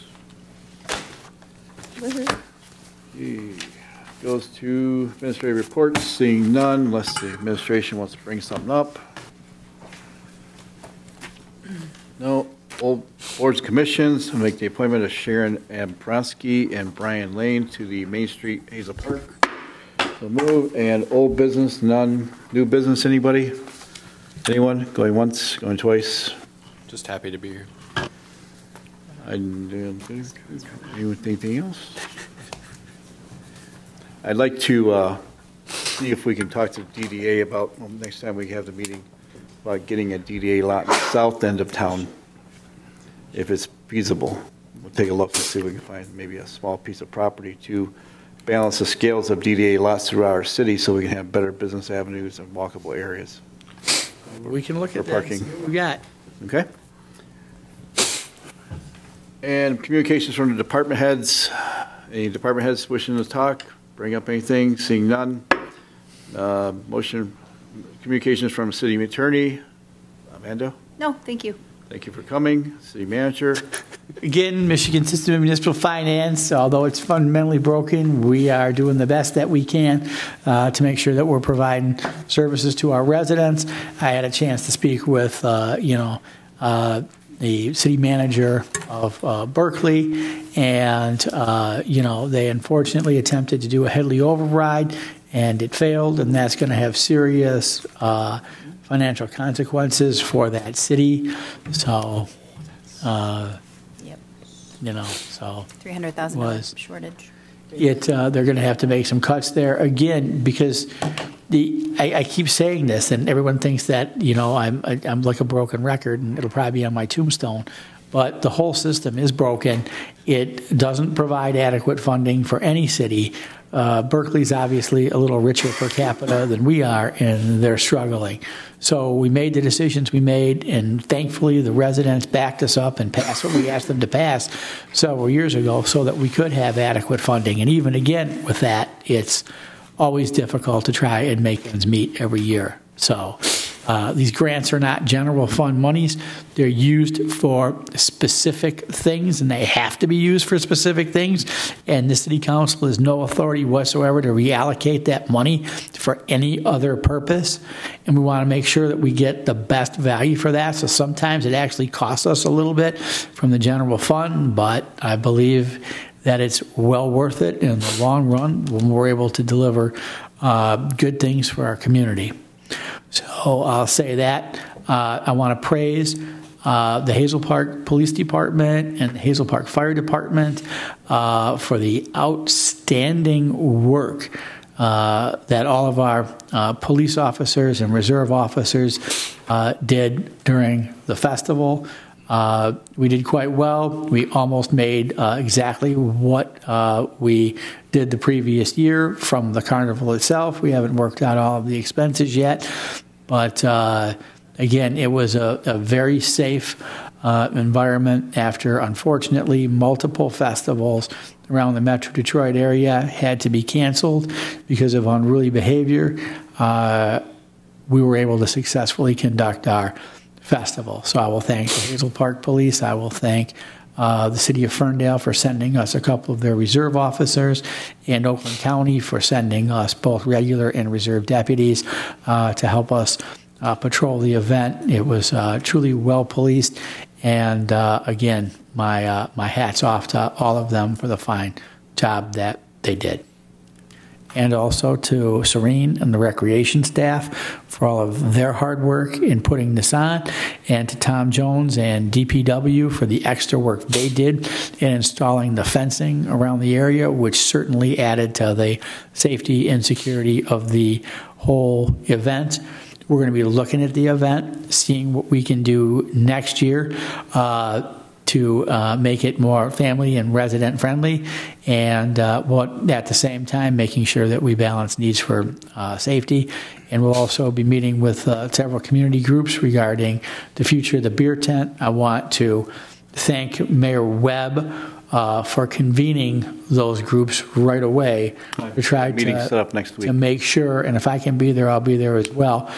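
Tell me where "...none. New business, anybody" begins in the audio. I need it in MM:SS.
00:21.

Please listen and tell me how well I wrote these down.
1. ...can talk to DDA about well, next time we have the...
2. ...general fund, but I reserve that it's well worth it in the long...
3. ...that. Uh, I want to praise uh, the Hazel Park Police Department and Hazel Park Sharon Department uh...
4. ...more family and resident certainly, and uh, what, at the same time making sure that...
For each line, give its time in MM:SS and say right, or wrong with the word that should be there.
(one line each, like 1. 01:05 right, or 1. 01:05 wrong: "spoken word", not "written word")
1. 00:36 right
2. 02:43 wrong: "believe", not "reserve"
3. 02:54 wrong: "Fire", not "Sharon"
4. 04:29 wrong: "friendly", not "certainly".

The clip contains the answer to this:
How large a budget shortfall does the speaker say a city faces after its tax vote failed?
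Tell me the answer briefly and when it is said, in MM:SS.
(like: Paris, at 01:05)
$300,000, at 01:45.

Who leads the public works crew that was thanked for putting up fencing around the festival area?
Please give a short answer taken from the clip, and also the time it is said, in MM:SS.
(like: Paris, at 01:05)
Tom Jones, at 04:10.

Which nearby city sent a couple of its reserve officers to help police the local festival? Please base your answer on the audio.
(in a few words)
Ferndale.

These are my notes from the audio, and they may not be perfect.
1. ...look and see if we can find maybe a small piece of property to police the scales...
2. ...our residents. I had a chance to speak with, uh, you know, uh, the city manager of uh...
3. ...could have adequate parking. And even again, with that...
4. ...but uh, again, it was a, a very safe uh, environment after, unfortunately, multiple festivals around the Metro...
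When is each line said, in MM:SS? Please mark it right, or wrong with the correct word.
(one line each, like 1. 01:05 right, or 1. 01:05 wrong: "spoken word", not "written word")
1. 00:45 wrong: "balance", not "police"
2. 01:22 right
3. 02:16 wrong: "funding", not "parking"
4. 03:23 right.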